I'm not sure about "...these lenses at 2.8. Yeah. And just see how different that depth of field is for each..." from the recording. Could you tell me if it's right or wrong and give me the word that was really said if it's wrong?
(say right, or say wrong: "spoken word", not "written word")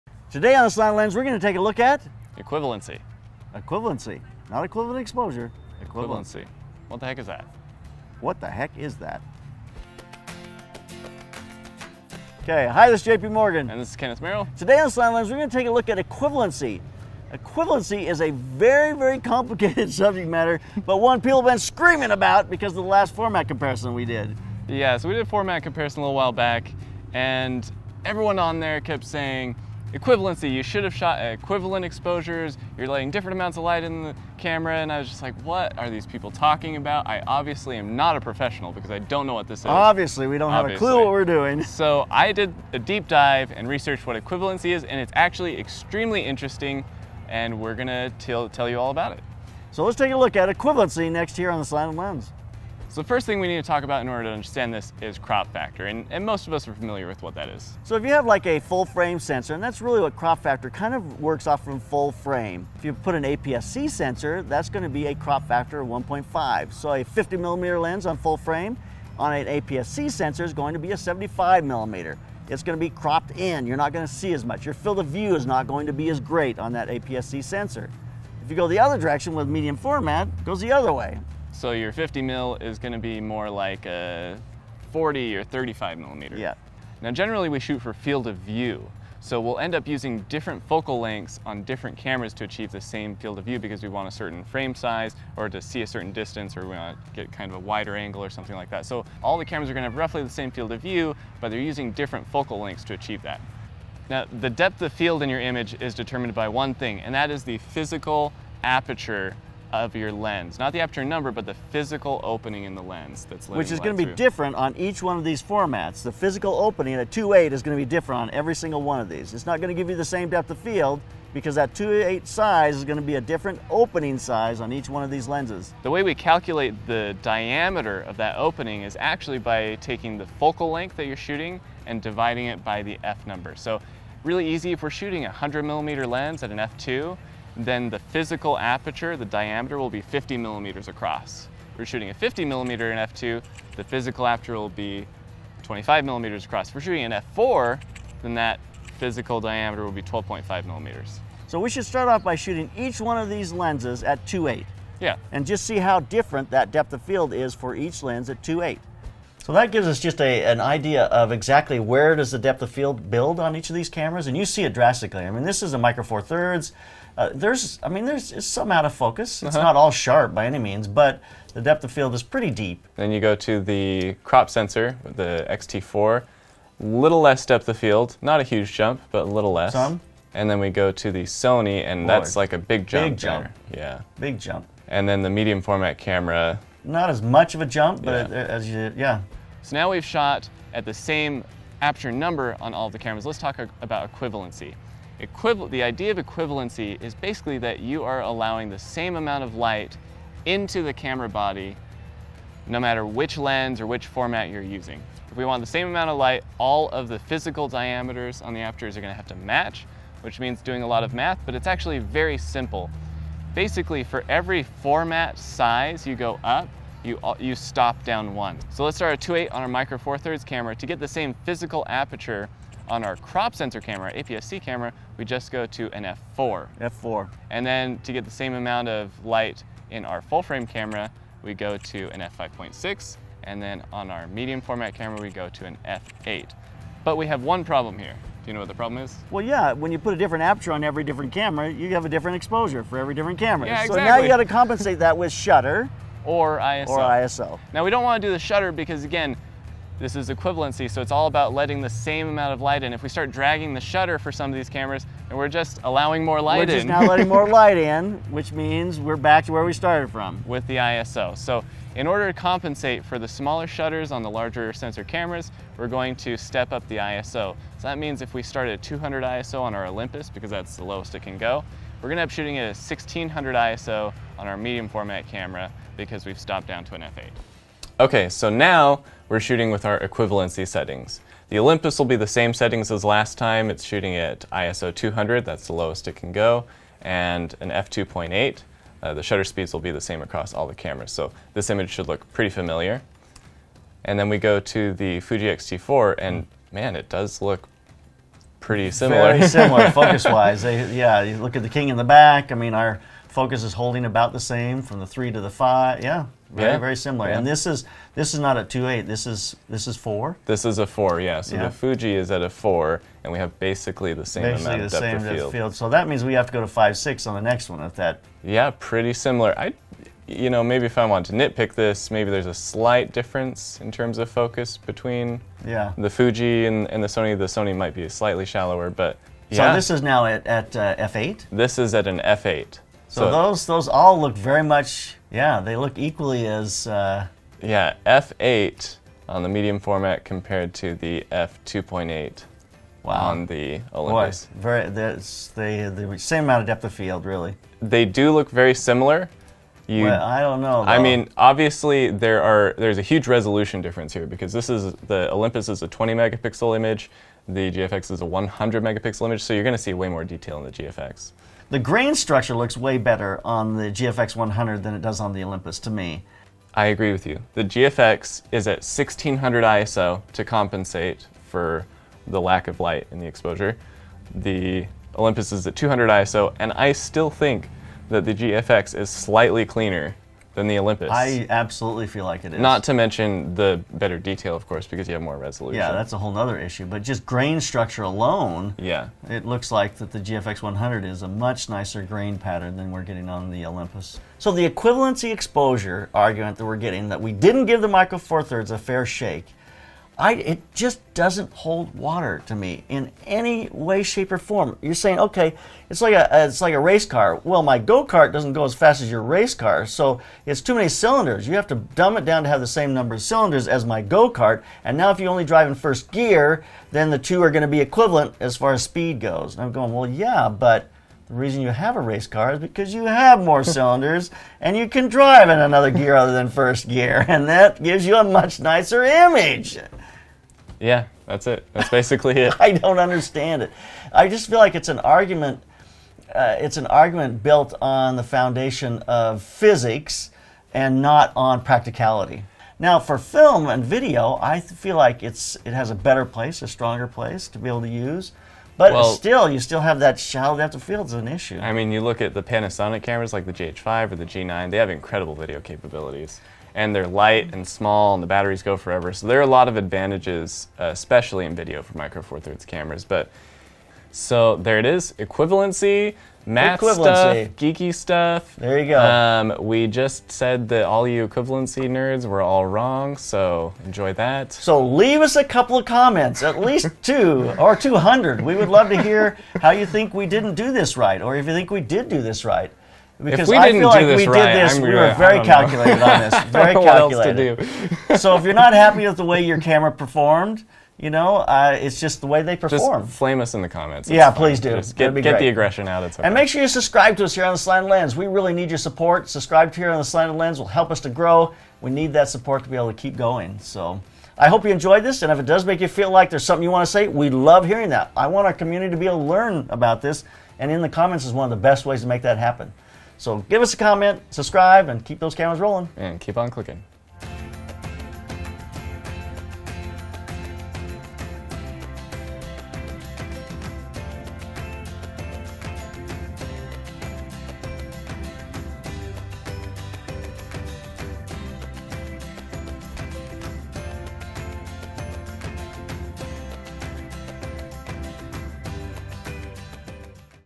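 right.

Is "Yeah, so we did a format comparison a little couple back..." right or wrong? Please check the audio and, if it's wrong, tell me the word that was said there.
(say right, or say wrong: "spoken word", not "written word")
wrong: "while", not "couple".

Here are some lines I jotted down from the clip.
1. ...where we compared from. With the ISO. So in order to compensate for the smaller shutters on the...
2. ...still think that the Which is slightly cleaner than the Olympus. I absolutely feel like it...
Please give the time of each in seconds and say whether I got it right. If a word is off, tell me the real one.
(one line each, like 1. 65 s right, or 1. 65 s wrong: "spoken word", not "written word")
1. 259 s wrong: "started", not "compared"
2. 376 s wrong: "GFX", not "Which".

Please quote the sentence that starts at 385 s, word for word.
Yeah, that's a whole other issue.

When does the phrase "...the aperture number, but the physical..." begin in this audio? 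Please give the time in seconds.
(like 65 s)
110 s.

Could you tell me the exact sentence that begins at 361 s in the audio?
The grain structure looks way better on the GFX 100 than it does on the Olympus to me.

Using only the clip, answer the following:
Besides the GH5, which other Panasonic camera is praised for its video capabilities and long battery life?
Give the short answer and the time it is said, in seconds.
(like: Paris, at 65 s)
G9, at 454 s.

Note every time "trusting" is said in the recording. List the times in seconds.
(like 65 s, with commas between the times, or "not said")
not said.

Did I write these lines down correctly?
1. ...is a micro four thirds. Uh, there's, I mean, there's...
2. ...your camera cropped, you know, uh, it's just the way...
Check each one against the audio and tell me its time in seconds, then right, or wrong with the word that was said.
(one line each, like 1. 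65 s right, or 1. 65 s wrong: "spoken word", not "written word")
1. 165 s right
2. 489 s wrong: "performed", not "cropped".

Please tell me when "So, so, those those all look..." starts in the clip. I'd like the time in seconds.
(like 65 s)
333 s.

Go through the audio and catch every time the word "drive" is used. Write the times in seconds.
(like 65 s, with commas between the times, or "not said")
415 s, 425 s.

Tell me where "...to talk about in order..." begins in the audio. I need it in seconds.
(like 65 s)
53 s.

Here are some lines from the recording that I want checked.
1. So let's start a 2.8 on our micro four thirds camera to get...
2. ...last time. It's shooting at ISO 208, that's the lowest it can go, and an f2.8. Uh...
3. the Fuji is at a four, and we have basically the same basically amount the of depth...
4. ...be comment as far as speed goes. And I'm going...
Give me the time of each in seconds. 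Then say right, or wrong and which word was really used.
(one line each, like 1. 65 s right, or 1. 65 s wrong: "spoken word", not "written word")
1. 218 s right
2. 283 s wrong: "200", not "208"
3. 311 s right
4. 417 s wrong: "equivalent", not "comment".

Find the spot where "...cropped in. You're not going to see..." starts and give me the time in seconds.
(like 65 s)
72 s.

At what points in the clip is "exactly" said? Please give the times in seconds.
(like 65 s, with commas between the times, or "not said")
161 s, 243 s.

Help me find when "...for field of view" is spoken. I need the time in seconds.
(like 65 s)
87 s.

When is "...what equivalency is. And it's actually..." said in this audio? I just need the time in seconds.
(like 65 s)
44 s.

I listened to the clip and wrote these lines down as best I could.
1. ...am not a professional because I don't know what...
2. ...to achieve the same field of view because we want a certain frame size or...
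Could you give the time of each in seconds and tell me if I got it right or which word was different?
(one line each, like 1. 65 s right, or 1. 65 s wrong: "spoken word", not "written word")
1. 37 s right
2. 92 s right.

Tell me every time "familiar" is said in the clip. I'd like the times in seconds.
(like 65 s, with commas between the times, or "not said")
56 s, 292 s.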